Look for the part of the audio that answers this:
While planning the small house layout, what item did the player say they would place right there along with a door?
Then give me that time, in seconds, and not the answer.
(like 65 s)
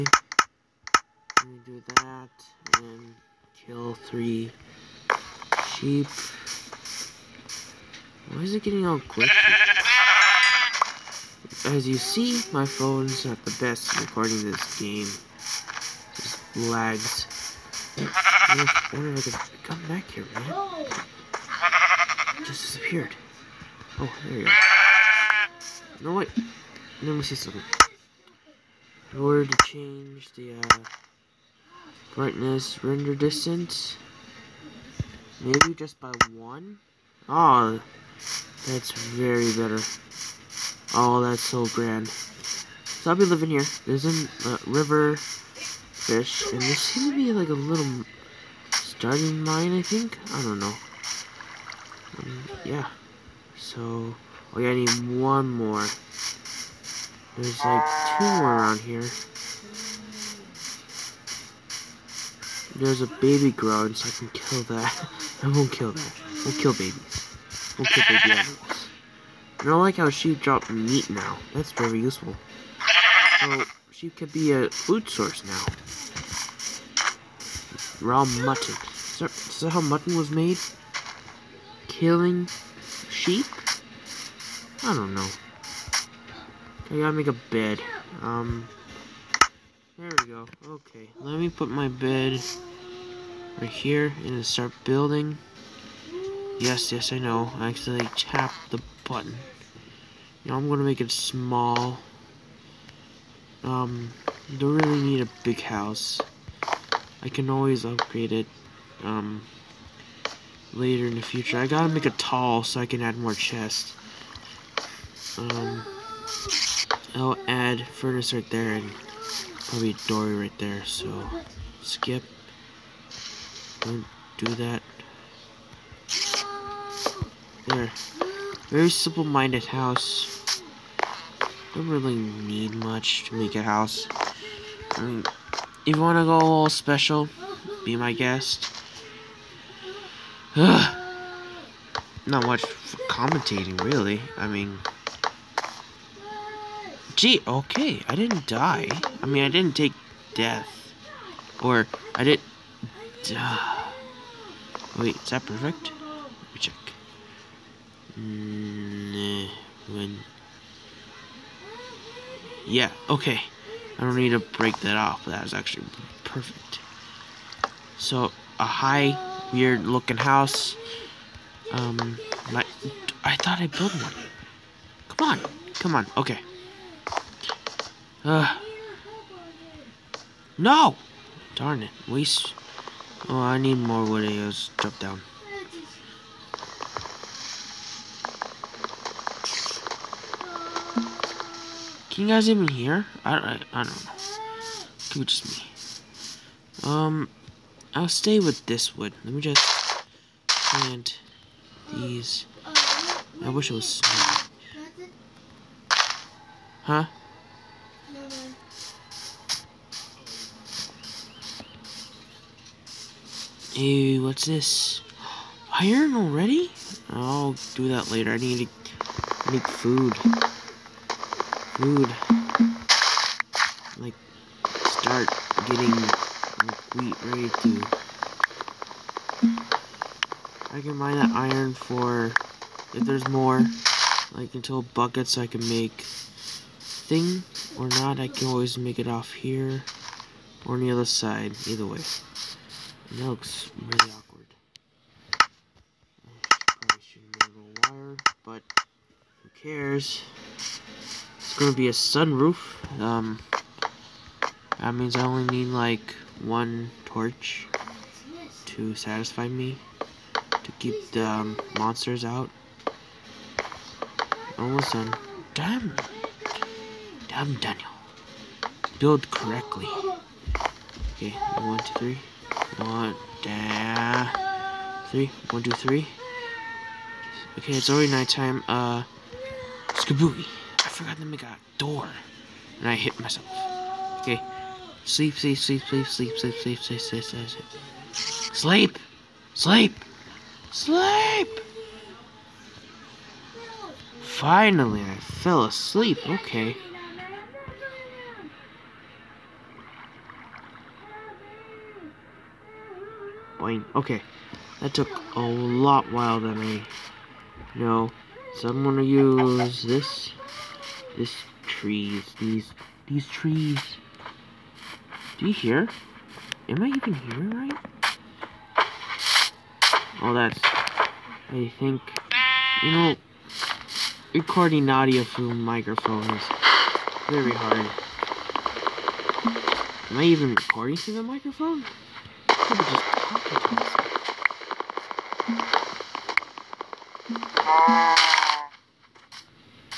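117 s.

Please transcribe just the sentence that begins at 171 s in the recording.
Um, I, I thought I built one.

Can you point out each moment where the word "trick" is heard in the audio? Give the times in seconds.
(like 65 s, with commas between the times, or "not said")
not said.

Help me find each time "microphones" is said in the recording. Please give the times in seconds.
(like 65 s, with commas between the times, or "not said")
325 s, 331 s.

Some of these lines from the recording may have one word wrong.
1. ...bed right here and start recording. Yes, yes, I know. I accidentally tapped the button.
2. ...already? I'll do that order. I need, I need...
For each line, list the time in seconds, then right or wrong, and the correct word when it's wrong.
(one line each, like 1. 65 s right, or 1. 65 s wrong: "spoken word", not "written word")
1. 91 s wrong: "building", not "recording"
2. 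216 s wrong: "later", not "order".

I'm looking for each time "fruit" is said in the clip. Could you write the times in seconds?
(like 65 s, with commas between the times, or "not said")
not said.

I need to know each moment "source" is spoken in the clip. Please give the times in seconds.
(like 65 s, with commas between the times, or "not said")
75 s.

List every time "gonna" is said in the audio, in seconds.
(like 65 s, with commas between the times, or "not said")
100 s, 308 s.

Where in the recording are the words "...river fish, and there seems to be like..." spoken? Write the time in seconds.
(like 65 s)
44 s.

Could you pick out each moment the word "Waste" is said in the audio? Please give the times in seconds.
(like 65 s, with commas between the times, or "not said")
182 s.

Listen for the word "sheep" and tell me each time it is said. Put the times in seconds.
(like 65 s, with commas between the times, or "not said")
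5 s, 83 s.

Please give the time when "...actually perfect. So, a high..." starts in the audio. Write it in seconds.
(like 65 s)
165 s.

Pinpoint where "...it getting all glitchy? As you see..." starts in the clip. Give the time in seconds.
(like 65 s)
8 s.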